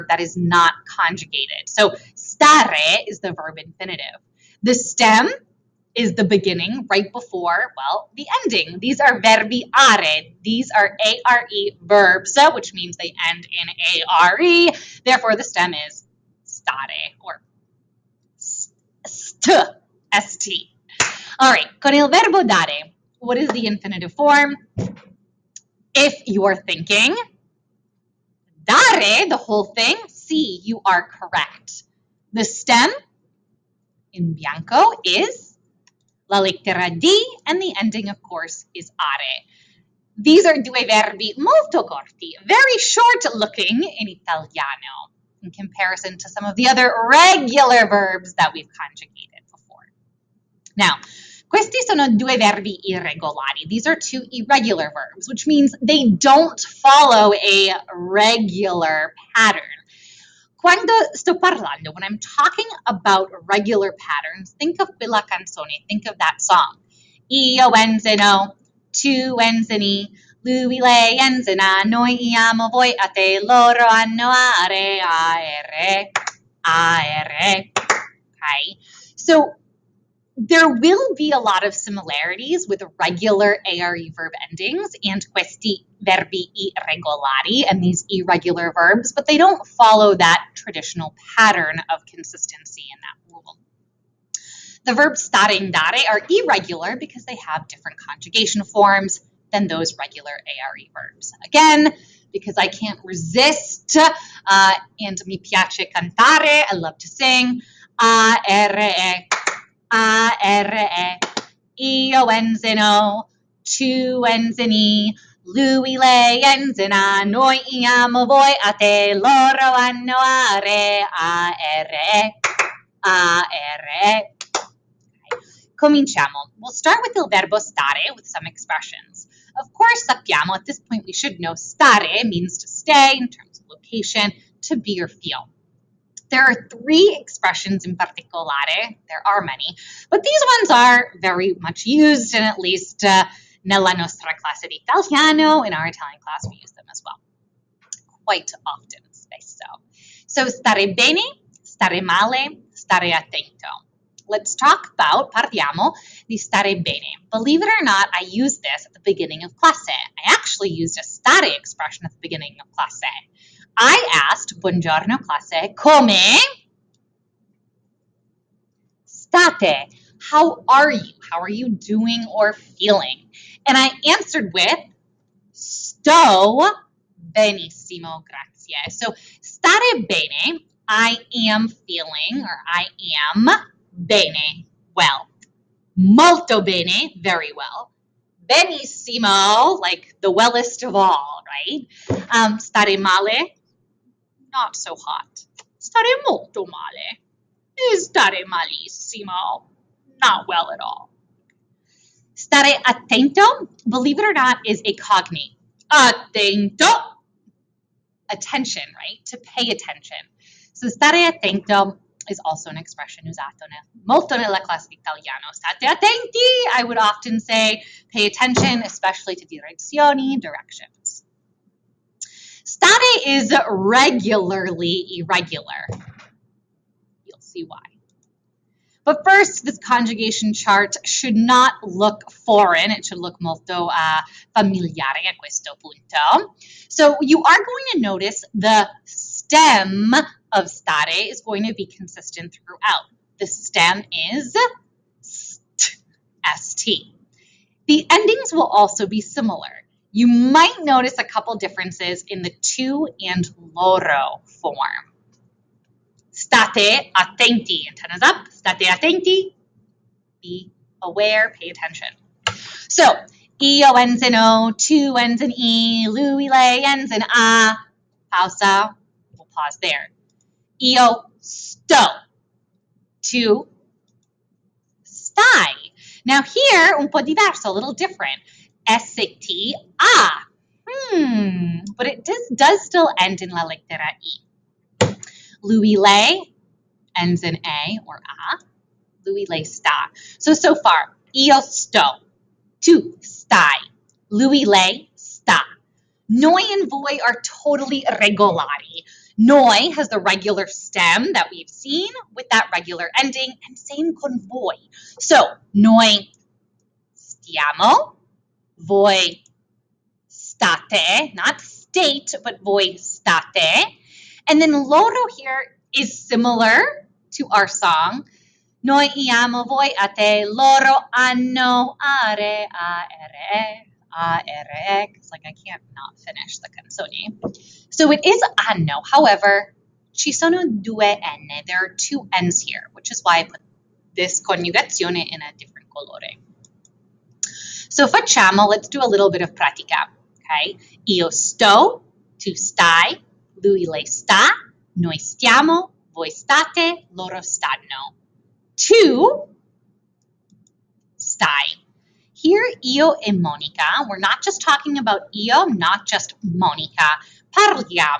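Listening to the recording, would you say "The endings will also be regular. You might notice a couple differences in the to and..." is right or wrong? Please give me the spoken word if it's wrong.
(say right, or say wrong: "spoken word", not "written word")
wrong: "similar", not "regular".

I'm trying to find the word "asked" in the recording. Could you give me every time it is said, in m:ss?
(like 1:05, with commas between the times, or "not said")
2:44.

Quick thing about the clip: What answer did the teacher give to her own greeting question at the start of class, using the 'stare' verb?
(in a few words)
Sto benissimo, grazie.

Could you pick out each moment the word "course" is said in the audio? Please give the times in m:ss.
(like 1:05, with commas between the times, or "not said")
0:38, 2:09.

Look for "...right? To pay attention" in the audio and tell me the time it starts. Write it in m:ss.
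3:28.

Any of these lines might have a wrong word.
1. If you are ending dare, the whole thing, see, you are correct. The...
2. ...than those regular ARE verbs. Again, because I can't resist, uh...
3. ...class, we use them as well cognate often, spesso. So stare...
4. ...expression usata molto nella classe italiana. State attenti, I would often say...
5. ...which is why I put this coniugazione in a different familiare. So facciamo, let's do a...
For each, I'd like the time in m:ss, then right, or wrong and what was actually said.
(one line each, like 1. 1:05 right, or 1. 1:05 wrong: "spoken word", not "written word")
1. 0:25 wrong: "thinking", not "ending"
2. 1:39 right
3. 2:26 wrong: "quite", not "cognate"
4. 3:32 right
5. 5:32 wrong: "colore", not "familiare".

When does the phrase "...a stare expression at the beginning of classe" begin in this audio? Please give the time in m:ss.
2:40.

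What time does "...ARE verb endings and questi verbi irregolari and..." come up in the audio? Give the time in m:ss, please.
1:23.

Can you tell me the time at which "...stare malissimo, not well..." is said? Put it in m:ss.
3:17.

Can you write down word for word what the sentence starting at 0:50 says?
Now, questi sono due verbi irregolari.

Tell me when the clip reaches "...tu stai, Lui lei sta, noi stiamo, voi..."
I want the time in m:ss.
5:42.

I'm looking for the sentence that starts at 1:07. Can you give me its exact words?
Io enzino, tu enzini, lui lei enzina, noi amo voi a te, loro hanno are, aere, aere.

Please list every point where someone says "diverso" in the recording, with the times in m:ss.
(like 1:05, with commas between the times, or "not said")
4:37.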